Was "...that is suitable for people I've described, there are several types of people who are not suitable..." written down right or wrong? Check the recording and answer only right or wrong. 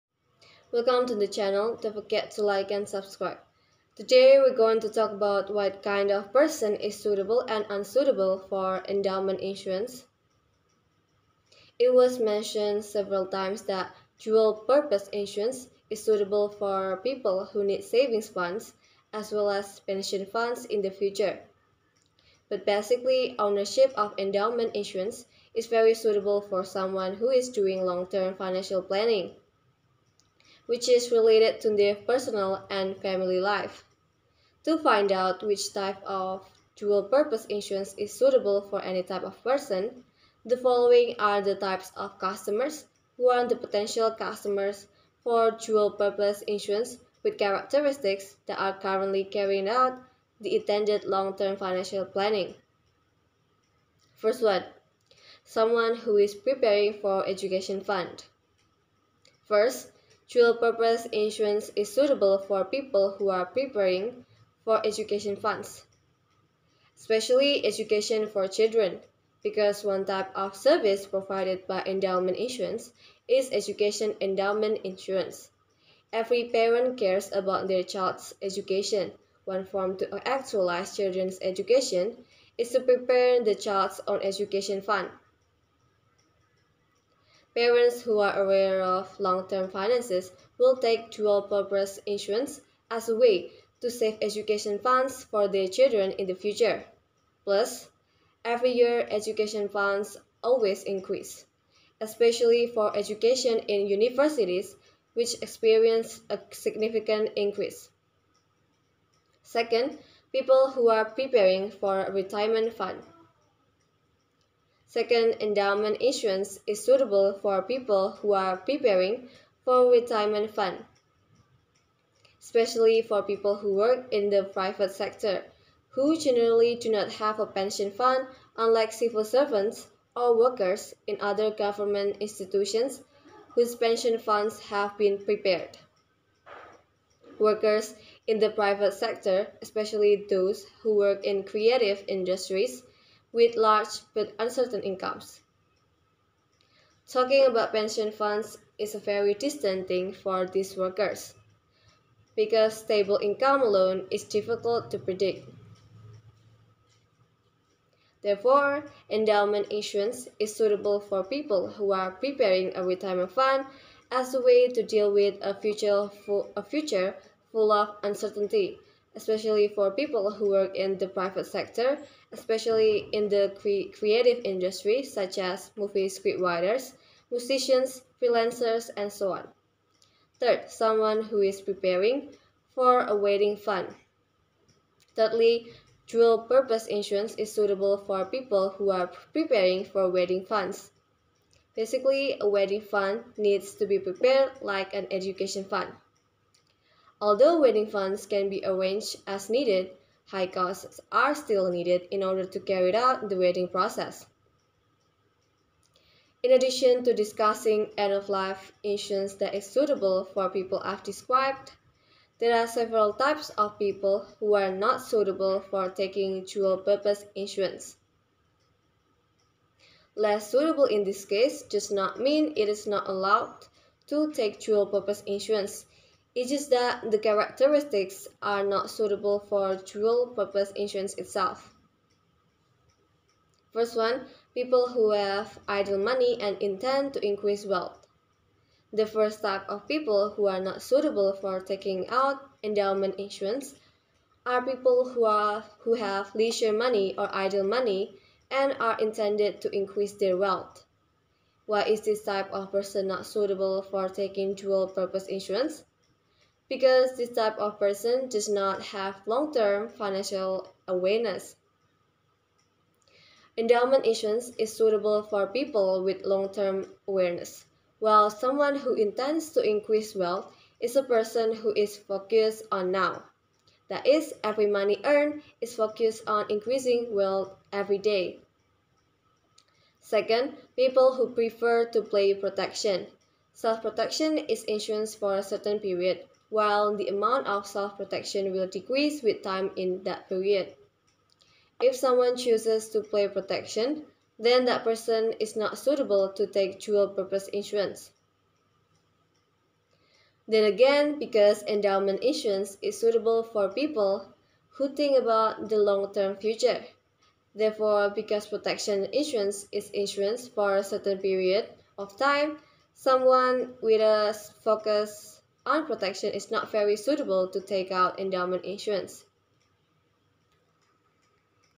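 right.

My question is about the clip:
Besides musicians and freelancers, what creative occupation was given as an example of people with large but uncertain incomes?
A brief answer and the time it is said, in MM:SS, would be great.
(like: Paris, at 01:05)
Movie scriptwriters, at 02:55.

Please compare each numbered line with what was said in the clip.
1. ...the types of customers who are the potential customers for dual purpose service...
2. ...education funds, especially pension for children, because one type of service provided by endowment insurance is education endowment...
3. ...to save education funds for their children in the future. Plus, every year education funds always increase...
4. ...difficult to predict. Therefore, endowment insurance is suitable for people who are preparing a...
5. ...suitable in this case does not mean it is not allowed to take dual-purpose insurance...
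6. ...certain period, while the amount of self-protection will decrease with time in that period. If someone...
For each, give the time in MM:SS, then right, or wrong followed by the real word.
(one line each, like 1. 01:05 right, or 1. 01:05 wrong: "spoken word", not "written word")
1. 00:41 wrong: "insurance", not "service"
2. 01:04 wrong: "education", not "pension"
3. 01:33 right
4. 02:34 right
5. 03:40 right
6. 04:45 right.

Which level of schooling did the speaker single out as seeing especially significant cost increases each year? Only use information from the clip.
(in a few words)
Universities.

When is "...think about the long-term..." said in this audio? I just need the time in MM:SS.
05:04.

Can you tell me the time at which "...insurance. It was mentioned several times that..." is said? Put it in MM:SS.
00:09.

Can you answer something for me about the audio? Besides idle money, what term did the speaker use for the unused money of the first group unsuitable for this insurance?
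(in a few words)
Leisure money.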